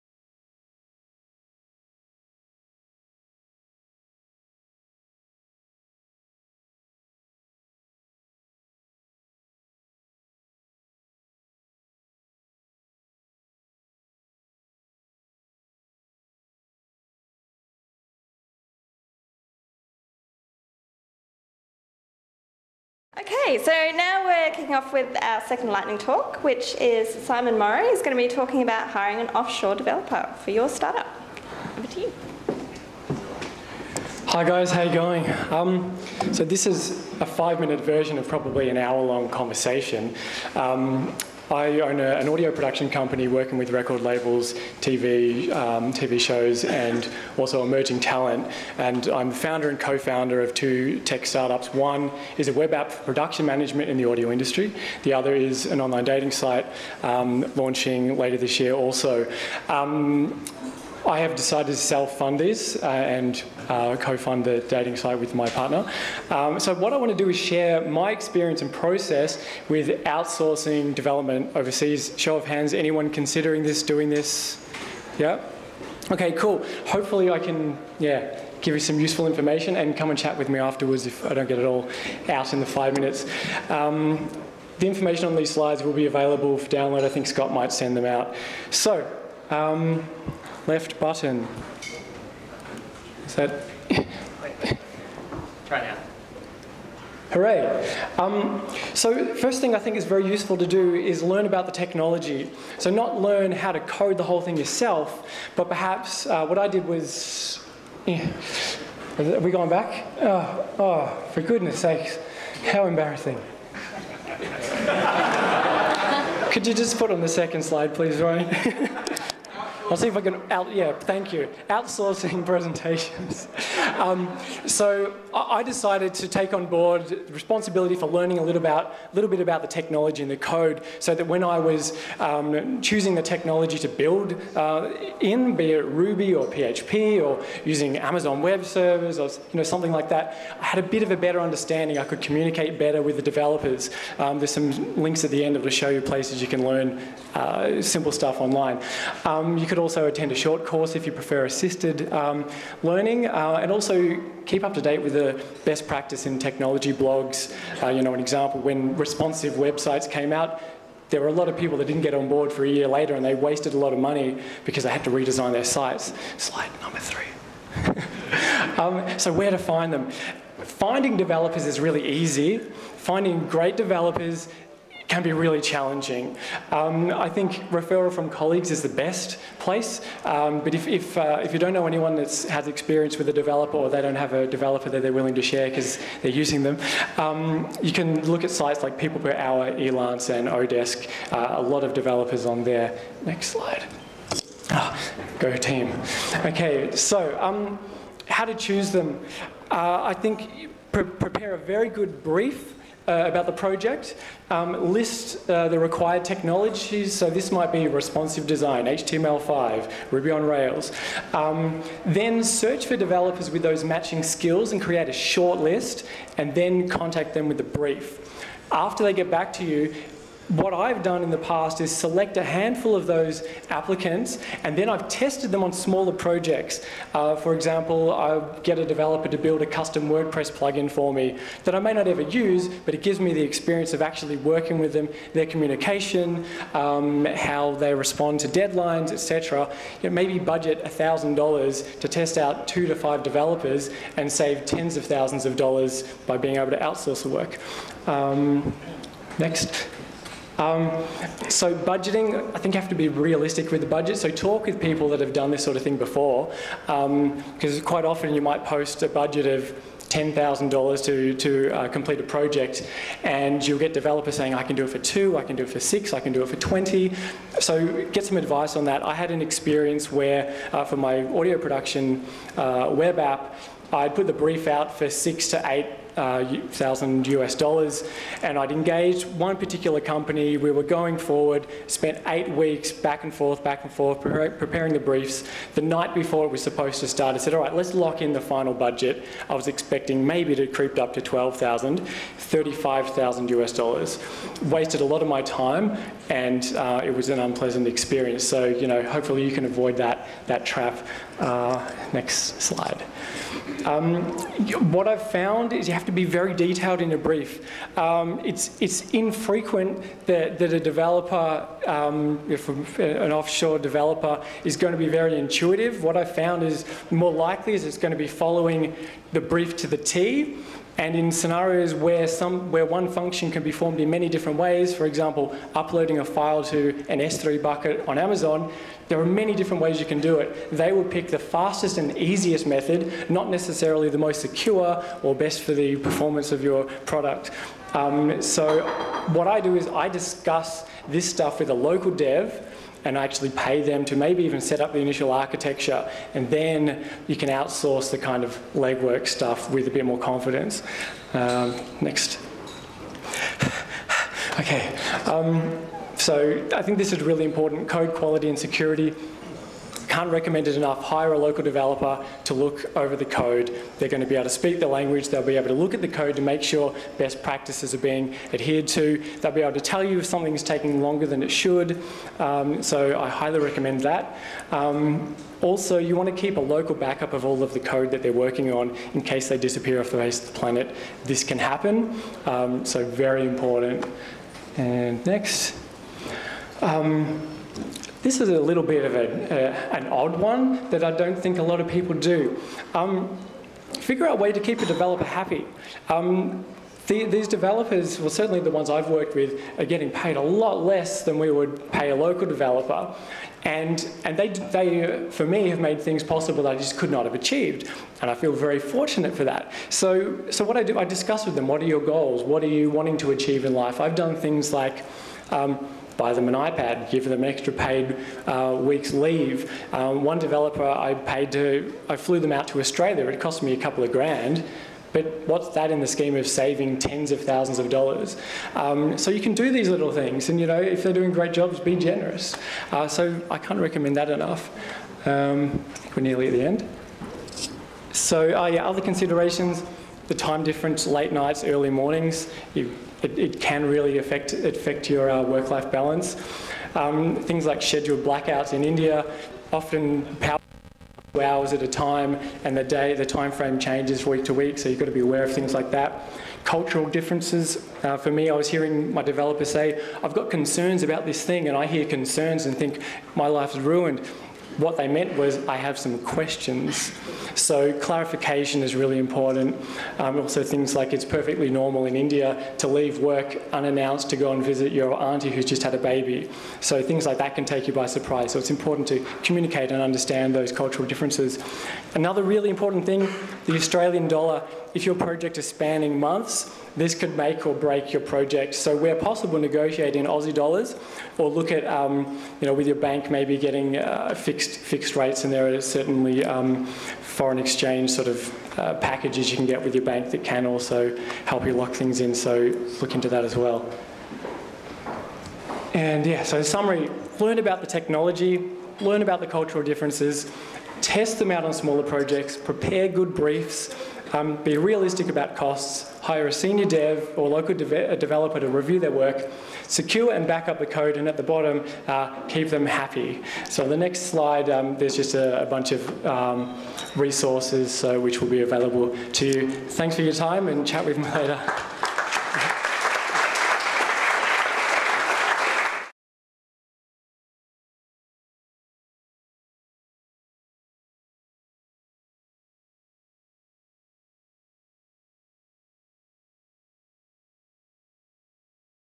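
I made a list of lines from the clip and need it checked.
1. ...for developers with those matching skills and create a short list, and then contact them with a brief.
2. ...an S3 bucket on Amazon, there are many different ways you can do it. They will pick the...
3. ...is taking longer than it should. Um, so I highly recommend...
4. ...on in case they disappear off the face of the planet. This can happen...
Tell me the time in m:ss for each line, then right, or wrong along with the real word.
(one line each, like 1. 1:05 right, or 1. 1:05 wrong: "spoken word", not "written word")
1. 3:32 right
2. 5:27 right
3. 6:10 right
4. 6:18 right.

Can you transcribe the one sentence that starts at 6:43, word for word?
And, and they, they, for me, have made things possible that I just could not have achieved.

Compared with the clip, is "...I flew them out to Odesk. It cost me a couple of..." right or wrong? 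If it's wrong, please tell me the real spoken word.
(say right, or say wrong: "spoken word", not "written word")
wrong: "Australia", not "Odesk".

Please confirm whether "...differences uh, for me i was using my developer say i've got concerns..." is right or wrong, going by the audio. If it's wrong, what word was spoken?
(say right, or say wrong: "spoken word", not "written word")
wrong: "hearing", not "using".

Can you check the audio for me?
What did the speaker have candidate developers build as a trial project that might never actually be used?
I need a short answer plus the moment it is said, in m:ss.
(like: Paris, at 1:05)
Custom WordPress plugin, at 3:49.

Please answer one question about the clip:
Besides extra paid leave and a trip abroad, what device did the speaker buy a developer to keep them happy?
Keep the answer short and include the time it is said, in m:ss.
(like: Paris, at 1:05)
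An iPad, at 6:56.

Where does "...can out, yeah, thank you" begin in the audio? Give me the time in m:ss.
2:00.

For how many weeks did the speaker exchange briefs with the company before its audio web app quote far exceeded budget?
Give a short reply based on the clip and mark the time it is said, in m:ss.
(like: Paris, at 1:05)
8 weeks, at 4:42.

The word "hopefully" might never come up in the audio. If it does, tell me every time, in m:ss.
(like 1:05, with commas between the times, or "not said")
1:16, 4:59.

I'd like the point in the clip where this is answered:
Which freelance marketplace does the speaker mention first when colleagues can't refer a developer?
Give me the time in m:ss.
3:08.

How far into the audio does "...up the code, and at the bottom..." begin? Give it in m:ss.
8:40.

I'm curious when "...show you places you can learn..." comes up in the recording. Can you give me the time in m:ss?
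2:25.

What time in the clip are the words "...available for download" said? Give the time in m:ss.
1:26.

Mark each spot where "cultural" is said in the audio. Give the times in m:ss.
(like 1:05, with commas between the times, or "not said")
7:36, 8:00, 8:29.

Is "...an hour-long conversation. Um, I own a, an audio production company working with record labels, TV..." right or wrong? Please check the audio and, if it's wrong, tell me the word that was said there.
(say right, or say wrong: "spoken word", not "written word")
right.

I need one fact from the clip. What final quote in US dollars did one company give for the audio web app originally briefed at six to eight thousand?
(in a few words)
35,000 US dollars.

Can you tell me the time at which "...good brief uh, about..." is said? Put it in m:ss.
3:21.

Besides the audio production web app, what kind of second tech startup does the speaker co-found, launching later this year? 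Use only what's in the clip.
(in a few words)
Online dating site.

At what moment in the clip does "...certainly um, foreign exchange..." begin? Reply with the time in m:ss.
8:15.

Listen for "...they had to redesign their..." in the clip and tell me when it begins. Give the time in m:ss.
2:44.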